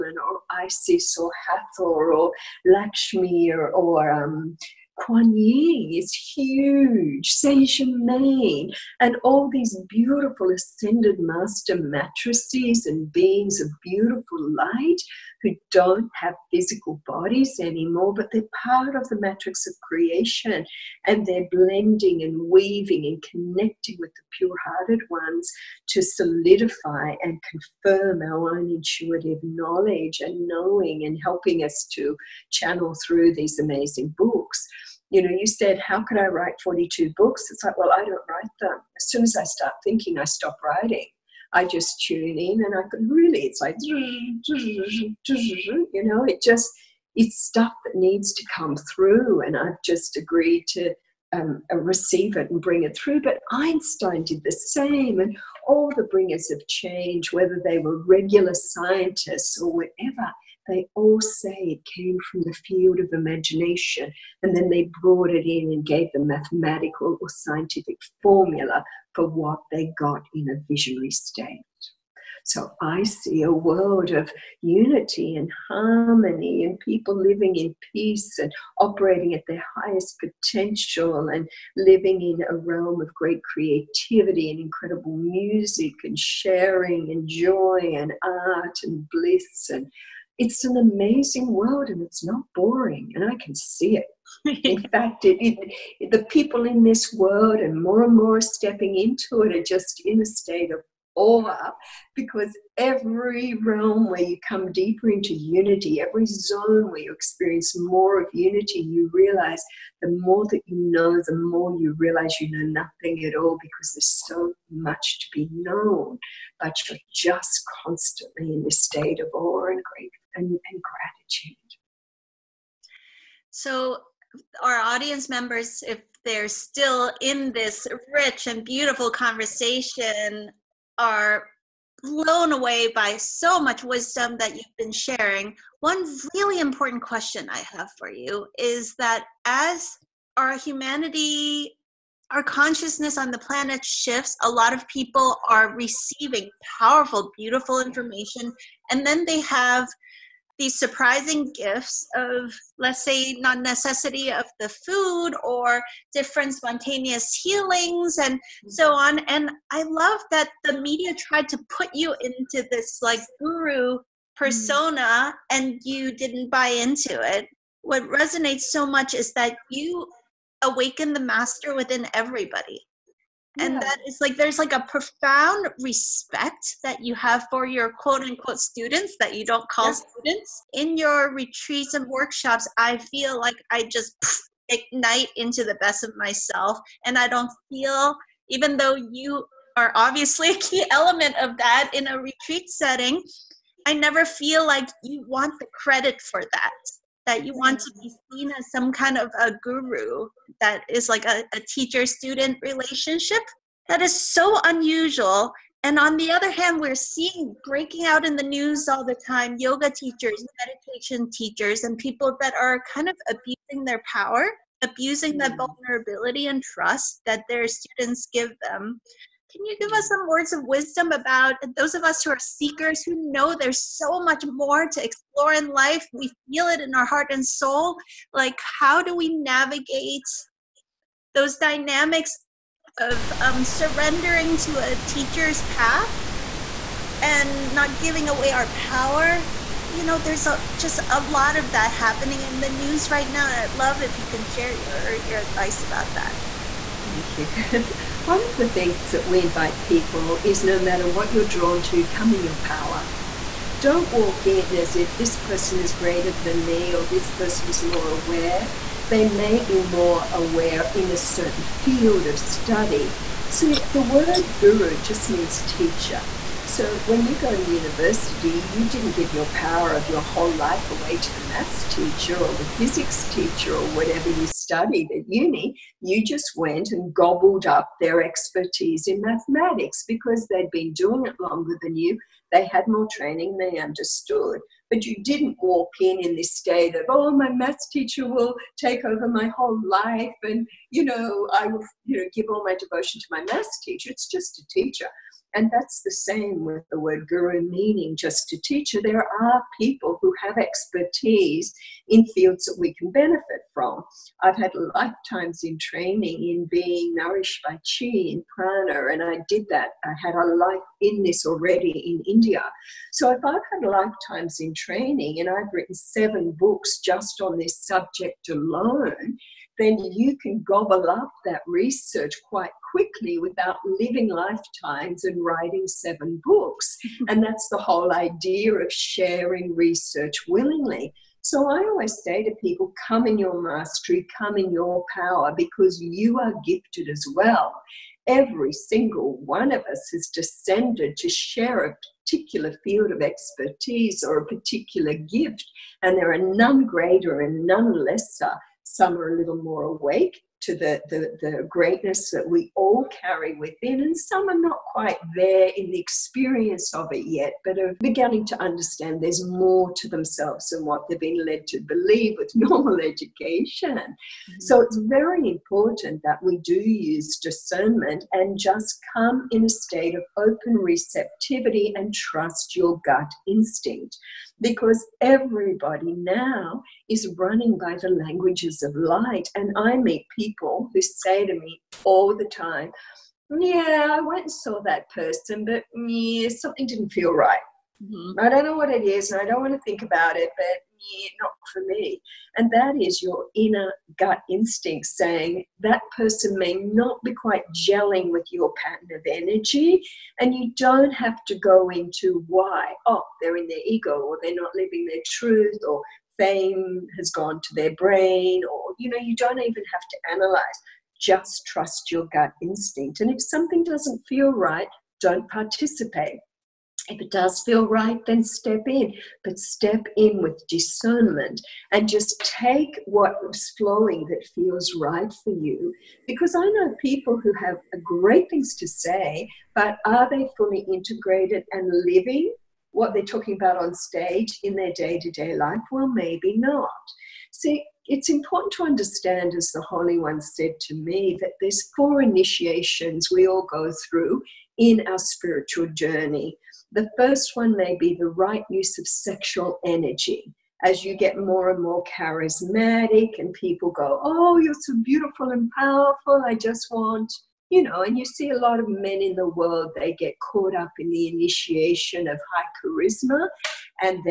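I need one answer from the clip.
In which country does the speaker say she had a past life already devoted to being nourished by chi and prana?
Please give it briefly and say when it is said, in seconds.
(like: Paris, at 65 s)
India, at 312 s.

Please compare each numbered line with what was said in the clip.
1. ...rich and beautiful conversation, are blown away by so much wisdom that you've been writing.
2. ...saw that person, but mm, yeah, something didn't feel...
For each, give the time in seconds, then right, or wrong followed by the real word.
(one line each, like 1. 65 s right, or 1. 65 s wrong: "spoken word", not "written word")
1. 128 s wrong: "sharing", not "writing"
2. 384 s right.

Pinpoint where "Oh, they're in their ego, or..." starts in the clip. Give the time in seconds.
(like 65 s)
403 s.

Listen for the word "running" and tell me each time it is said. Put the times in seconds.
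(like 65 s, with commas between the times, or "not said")
377 s.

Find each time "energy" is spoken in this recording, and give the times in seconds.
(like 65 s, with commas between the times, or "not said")
399 s, 449 s.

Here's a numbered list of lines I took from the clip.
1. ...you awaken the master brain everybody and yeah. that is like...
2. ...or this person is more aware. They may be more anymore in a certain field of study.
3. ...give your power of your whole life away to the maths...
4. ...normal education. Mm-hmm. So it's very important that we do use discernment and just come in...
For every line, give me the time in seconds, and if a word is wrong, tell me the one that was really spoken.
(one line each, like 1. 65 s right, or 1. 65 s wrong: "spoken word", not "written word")
1. 169 s wrong: "within", not "brain"
2. 256 s wrong: "aware", not "anymore"
3. 269 s right
4. 362 s right.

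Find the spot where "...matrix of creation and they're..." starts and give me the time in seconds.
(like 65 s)
19 s.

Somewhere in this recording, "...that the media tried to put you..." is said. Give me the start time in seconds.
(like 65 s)
160 s.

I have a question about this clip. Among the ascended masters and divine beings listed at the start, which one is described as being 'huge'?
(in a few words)
Kuan Yin.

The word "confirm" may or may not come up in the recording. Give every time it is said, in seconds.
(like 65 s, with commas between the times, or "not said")
27 s.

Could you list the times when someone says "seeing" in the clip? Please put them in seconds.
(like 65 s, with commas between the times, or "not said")
206 s.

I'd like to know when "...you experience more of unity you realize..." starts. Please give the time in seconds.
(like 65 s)
106 s.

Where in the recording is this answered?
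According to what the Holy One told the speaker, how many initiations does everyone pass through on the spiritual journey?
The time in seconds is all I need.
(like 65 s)
441 s.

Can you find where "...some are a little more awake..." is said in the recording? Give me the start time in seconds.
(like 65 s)
348 s.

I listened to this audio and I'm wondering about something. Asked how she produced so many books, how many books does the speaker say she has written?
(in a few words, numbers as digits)
42.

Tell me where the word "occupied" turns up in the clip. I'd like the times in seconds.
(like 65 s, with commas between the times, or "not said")
not said.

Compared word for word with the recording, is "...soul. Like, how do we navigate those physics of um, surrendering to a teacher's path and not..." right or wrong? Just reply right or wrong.
wrong.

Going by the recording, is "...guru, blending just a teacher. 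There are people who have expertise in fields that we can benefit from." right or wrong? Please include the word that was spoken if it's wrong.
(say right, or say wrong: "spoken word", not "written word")
wrong: "meaning", not "blending".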